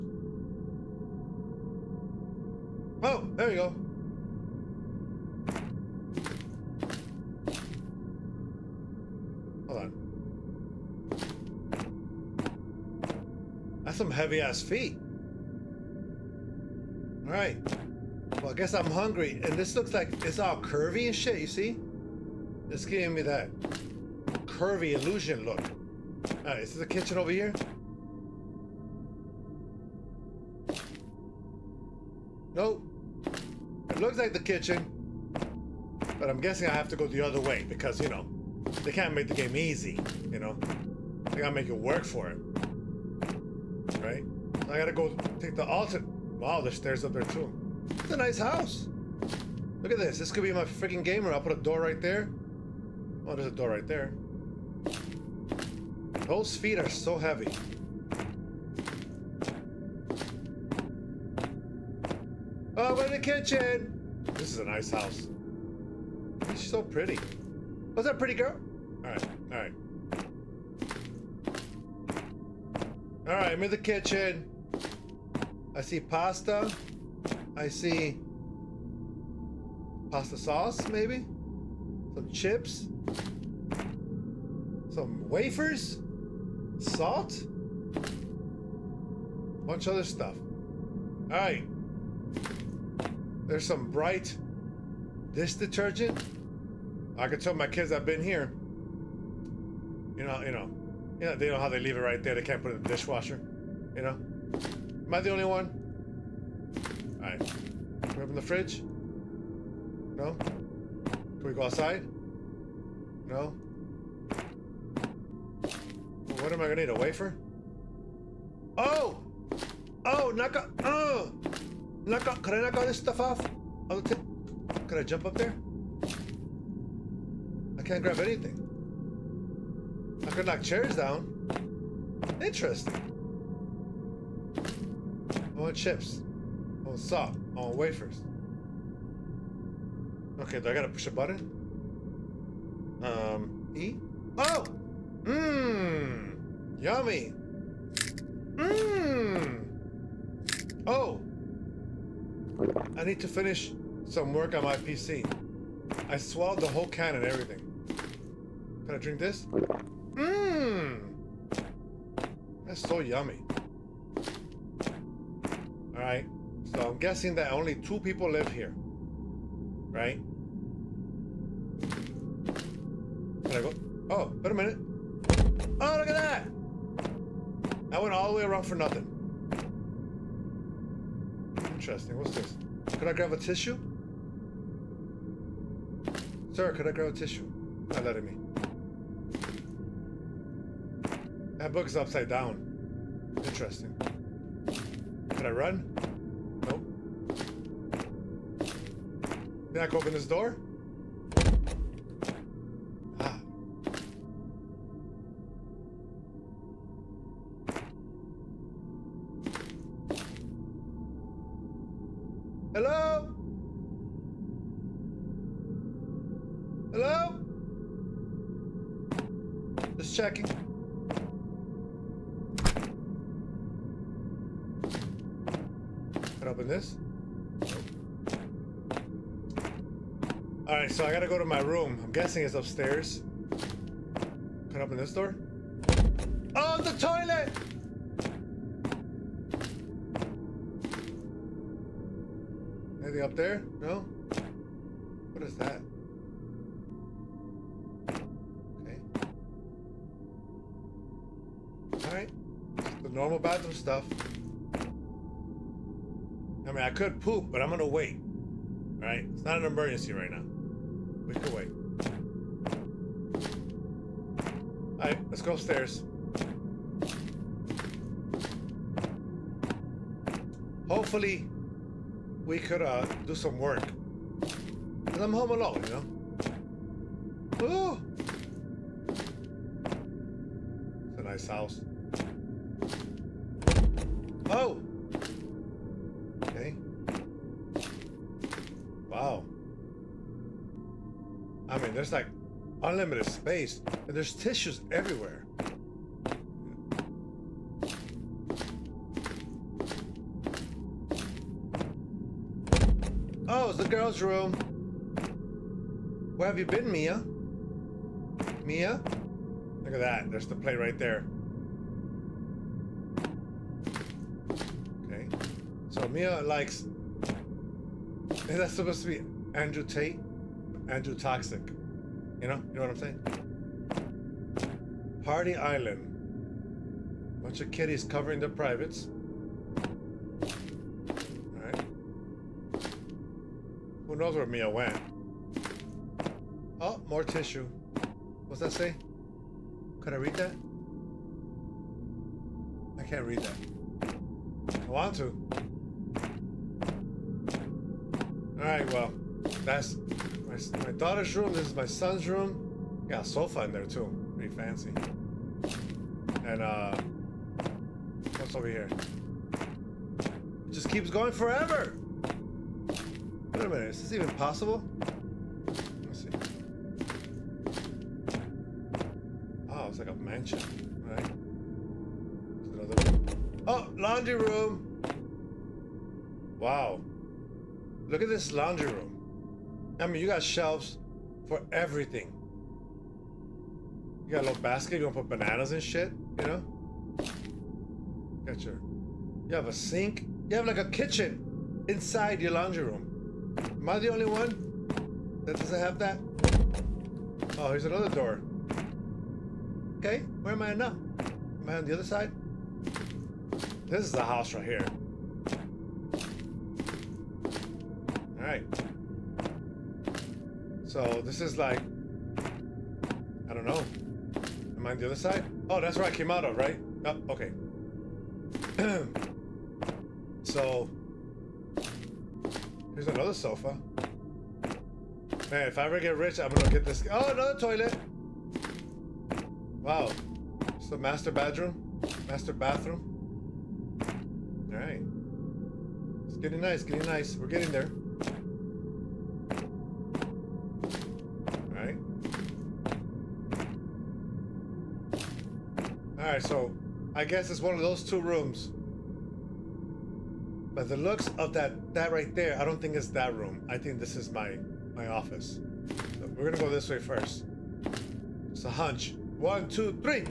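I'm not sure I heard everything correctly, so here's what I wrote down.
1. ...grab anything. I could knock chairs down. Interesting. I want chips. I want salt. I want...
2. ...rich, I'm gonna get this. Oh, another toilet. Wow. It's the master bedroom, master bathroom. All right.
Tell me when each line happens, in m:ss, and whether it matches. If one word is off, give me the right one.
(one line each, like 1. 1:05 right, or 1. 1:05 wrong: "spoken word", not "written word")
1. 2:08 right
2. 7:06 right.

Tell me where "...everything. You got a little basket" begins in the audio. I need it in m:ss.
6:21.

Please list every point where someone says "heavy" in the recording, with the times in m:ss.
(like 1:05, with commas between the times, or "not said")
0:14, 0:57.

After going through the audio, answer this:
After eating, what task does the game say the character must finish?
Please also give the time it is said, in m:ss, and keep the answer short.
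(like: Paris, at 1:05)
work on my PC, at 2:34.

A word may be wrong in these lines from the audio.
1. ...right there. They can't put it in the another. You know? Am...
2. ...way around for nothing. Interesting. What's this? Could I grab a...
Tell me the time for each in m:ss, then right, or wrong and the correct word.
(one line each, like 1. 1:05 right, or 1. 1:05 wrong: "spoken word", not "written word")
1. 1:42 wrong: "dishwasher", not "another"
2. 2:58 right.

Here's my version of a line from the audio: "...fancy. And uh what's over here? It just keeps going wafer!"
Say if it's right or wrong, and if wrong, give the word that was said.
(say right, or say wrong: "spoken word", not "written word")
wrong: "forever", not "wafer".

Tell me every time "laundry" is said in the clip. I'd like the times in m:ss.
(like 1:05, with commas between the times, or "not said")
6:13, 6:18, 6:32.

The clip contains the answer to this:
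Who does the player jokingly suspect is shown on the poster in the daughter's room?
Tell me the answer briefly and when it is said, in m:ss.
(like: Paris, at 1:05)
Andrew Tate, at 5:19.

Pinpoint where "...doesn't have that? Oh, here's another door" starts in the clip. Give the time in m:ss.
6:35.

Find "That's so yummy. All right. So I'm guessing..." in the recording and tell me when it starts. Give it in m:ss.
2:42.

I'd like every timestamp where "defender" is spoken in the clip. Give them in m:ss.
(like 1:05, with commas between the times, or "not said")
not said.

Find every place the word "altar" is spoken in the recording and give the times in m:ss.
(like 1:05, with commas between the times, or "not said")
0:45.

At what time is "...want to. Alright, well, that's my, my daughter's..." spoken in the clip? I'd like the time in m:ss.
5:44.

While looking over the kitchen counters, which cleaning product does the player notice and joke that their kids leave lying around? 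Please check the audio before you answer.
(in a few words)
dish detergent.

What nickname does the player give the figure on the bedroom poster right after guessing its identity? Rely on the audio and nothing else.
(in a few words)
Andrew Toxic.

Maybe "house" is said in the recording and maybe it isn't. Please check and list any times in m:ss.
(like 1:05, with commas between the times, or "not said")
0:48, 1:04, 4:41, 6:44.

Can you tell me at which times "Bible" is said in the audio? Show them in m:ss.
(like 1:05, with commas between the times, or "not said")
not said.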